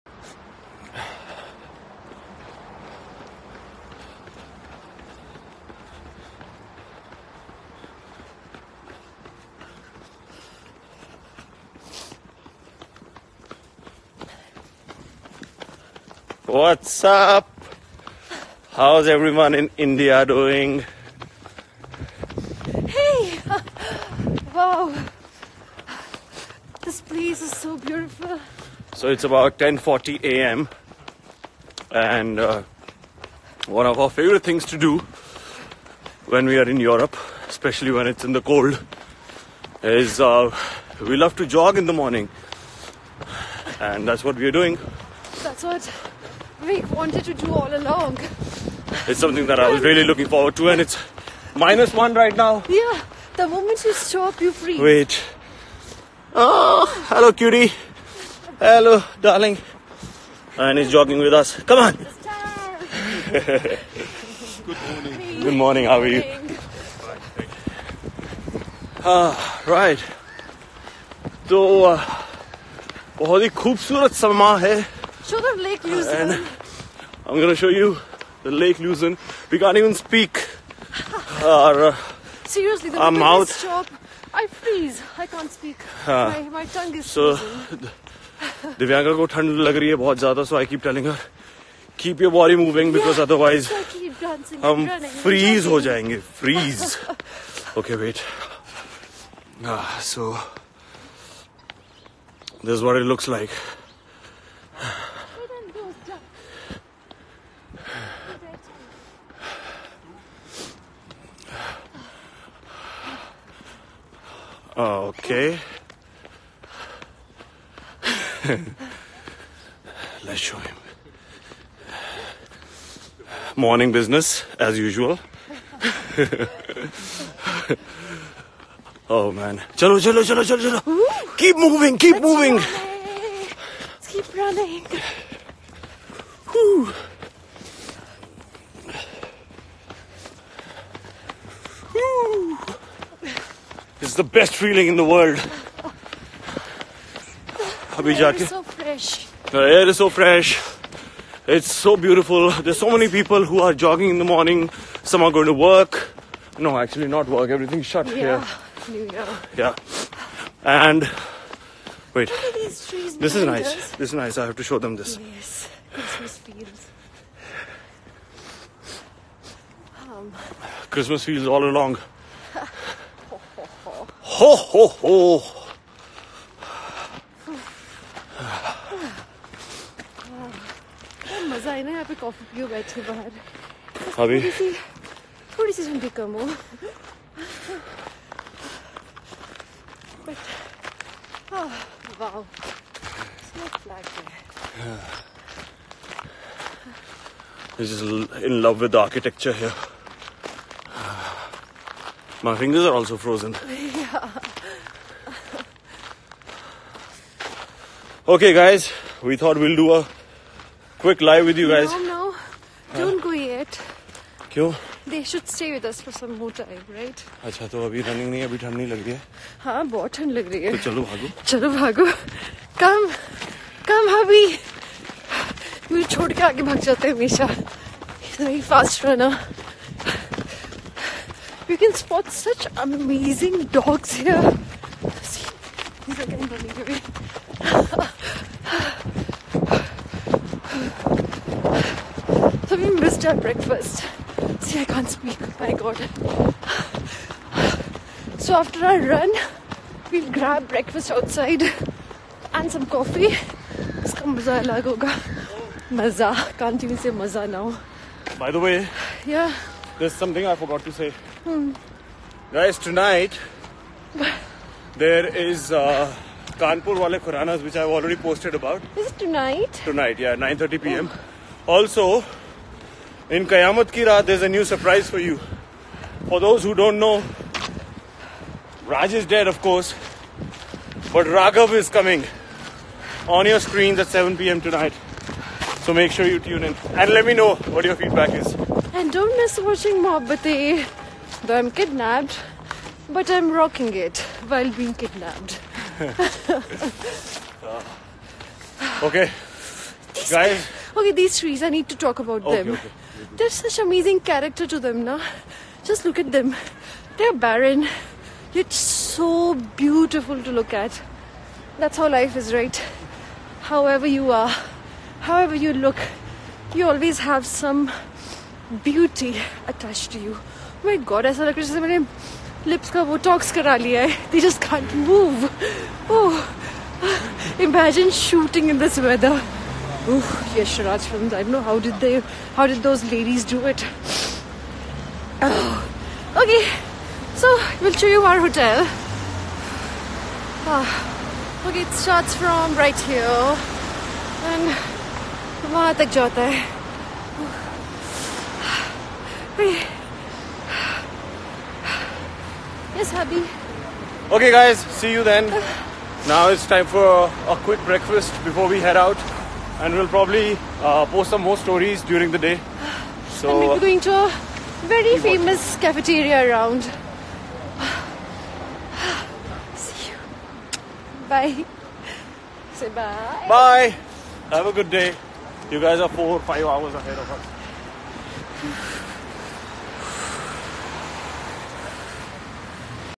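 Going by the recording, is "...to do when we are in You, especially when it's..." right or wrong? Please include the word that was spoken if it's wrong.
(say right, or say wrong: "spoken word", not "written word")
wrong: "Europe", not "You".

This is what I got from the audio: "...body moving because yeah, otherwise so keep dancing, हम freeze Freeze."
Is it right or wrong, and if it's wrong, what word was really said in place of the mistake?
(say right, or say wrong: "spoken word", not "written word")
right.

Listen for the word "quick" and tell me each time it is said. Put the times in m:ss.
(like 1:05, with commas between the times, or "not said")
3:30, 5:57.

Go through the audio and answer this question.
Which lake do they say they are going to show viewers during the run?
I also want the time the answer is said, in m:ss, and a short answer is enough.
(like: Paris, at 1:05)
Lake Luzon, at 1:18.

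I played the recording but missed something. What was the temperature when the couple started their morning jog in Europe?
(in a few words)
minus 1.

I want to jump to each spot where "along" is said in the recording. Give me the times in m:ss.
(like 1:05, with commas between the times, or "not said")
0:47, 2:51.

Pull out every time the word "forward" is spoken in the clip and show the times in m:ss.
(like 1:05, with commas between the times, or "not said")
0:50.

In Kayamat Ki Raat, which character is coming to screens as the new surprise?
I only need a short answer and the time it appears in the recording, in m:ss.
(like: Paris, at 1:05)
Raghav, at 4:41.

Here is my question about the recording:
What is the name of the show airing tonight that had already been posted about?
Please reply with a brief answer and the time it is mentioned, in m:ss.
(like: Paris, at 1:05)
Kanpur Wale Khuranas, at 4:26.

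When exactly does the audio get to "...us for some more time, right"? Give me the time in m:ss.
3:35.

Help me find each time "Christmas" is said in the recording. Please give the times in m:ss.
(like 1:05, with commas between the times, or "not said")
2:45, 2:50.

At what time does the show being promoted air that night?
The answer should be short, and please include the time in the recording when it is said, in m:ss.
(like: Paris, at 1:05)
9:30 p.m., at 4:30.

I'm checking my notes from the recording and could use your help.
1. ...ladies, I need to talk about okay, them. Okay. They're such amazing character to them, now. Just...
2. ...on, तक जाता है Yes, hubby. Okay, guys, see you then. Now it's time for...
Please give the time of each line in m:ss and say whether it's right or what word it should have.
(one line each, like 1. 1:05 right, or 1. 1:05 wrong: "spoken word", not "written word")
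1. 5:01 wrong: "trees", not "ladies"
2. 5:45 right.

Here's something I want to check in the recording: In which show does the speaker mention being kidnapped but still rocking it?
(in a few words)
Mohabbatein.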